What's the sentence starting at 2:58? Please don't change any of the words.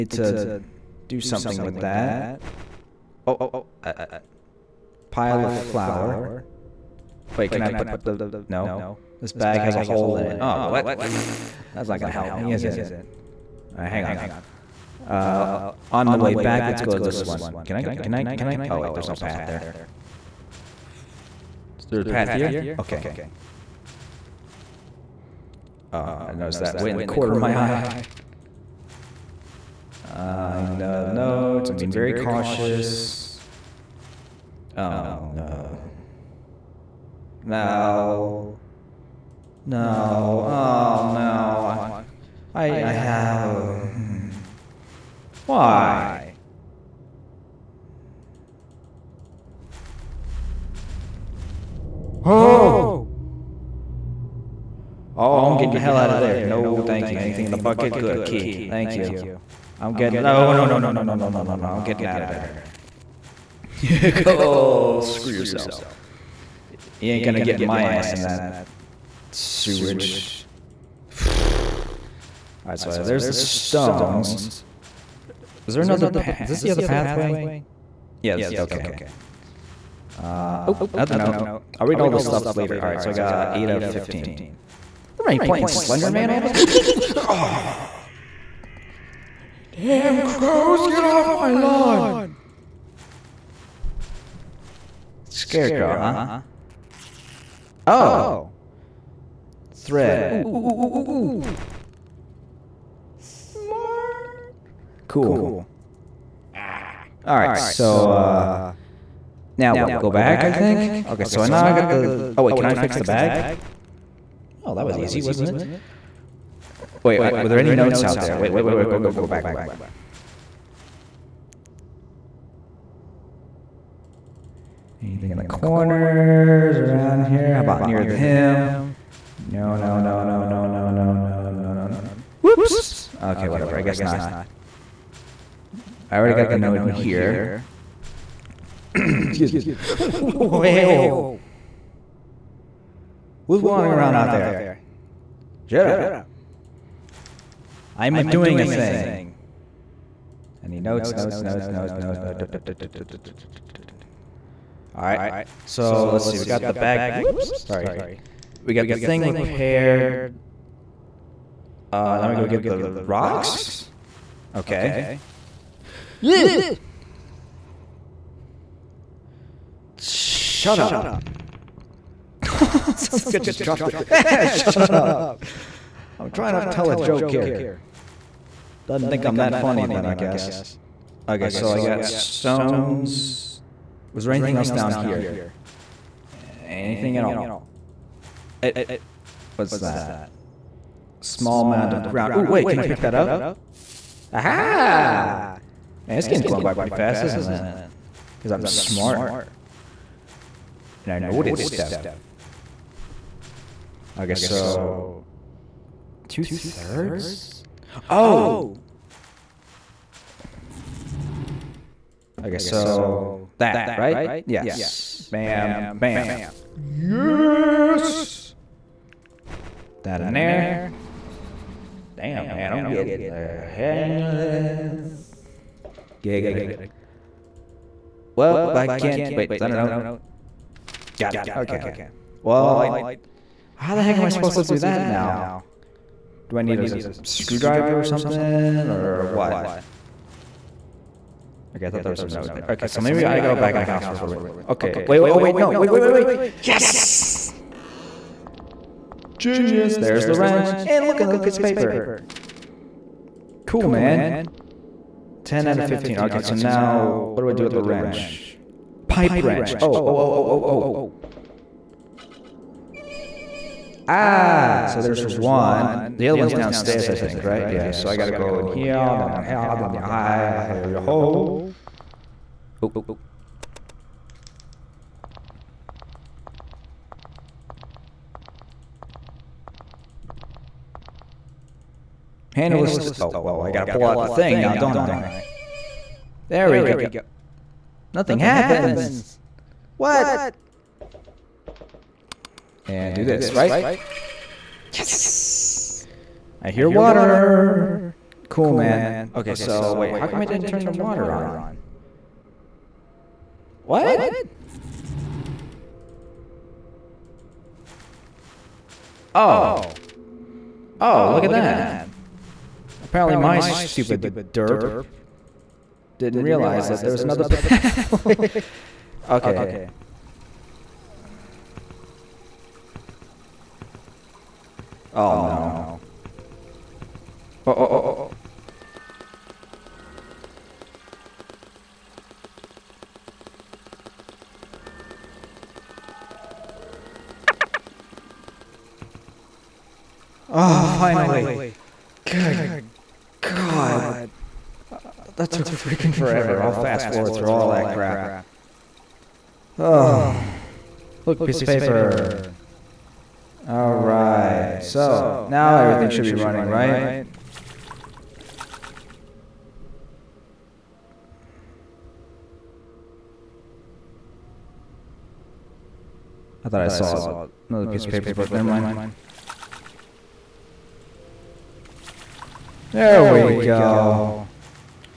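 Doesn't think I'm that funny then, I guess.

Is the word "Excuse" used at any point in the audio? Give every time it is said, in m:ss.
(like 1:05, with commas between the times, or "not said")
2:18.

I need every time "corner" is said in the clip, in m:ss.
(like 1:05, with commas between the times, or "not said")
0:27, 2:05.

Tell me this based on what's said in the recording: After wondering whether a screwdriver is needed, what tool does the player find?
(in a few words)
Pipe wrench.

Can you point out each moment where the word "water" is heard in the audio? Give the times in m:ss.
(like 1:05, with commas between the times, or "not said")
4:56, 5:00.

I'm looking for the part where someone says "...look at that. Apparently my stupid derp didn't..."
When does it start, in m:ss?
5:11.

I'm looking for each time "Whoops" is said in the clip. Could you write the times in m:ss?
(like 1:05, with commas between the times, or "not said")
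2:12, 2:37.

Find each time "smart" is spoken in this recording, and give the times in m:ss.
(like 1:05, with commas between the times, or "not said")
1:43, 3:18.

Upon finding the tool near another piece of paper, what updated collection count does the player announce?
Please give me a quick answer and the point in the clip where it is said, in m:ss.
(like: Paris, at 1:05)
10 out of 15, at 4:15.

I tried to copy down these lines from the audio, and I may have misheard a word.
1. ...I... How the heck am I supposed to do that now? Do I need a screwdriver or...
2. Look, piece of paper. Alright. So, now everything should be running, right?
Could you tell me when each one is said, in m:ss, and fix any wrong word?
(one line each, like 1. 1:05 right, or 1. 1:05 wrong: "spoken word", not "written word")
1. 3:52 right
2. 5:51 right.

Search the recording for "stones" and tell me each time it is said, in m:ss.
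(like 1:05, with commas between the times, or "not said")
1:13, 3:02.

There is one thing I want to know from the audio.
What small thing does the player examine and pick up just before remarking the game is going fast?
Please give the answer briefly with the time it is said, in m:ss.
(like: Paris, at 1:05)
Small mound of ground, at 3:11.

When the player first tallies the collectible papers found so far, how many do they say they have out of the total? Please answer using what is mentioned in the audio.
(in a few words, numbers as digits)
8 out of 15.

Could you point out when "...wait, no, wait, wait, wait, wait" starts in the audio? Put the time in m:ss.
4:05.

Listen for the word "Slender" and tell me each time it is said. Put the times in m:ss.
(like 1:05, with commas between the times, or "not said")
1:25.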